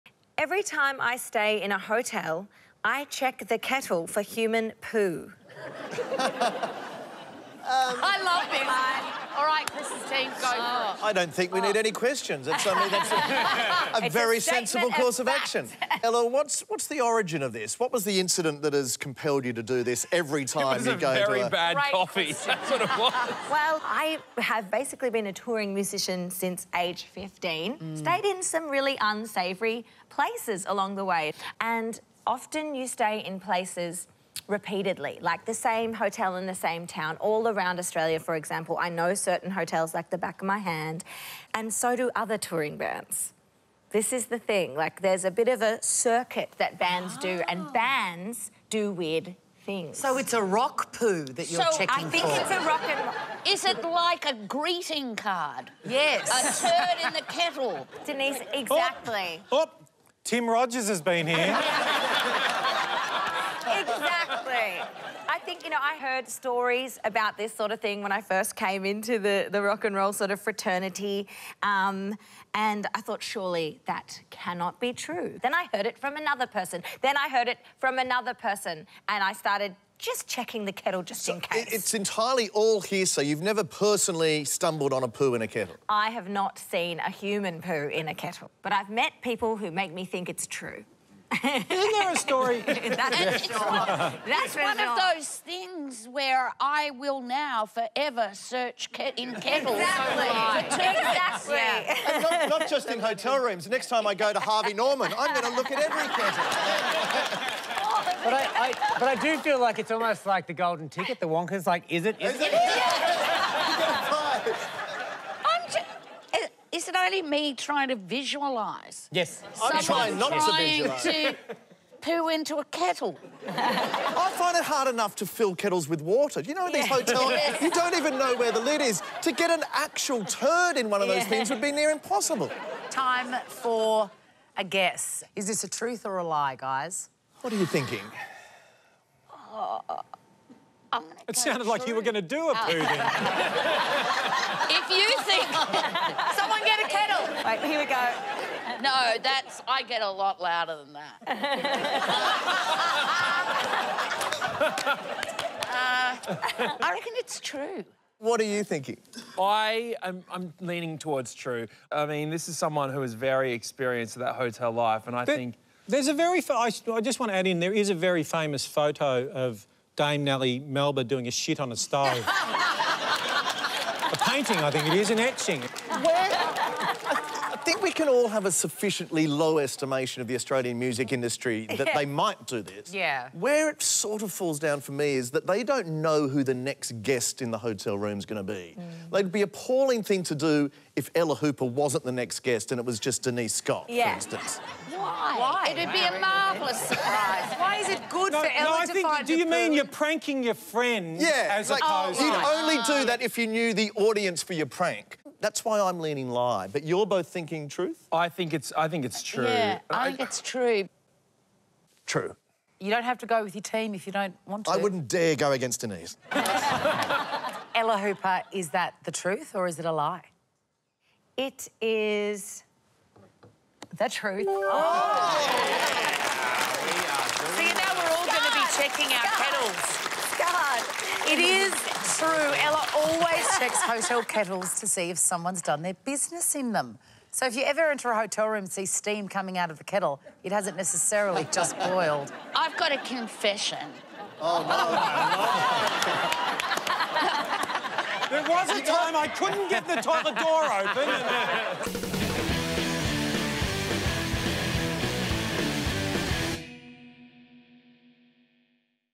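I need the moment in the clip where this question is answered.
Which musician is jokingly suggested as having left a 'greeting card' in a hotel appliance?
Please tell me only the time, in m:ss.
1:00.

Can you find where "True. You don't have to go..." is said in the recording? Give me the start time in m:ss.
3:32.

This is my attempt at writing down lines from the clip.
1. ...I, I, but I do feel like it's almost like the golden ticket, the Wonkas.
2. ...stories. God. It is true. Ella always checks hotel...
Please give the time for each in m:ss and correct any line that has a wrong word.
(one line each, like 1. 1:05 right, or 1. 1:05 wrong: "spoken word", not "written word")
1. 1:48 right
2. 3:49 wrong: "kettles", not "stories".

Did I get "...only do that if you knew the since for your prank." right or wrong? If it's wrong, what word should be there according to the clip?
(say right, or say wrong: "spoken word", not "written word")
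wrong: "audience", not "since".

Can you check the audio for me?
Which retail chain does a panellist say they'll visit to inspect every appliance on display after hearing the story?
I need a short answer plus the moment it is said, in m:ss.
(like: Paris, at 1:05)
Harvey Norman, at 1:44.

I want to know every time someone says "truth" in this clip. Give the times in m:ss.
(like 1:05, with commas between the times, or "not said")
2:15, 3:27, 3:39, 3:44.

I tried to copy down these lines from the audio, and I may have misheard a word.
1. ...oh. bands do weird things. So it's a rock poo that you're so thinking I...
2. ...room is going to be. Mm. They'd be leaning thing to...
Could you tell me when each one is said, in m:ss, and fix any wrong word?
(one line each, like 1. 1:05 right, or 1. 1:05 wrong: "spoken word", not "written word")
1. 0:47 wrong: "checking", not "thinking"
2. 3:07 wrong: "appalling", not "leaning".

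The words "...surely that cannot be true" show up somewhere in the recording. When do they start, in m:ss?
1:13.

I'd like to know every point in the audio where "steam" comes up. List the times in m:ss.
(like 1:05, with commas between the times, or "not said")
3:58.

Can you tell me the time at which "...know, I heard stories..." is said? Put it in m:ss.
1:05.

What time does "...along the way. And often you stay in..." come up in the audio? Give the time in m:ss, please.
0:30.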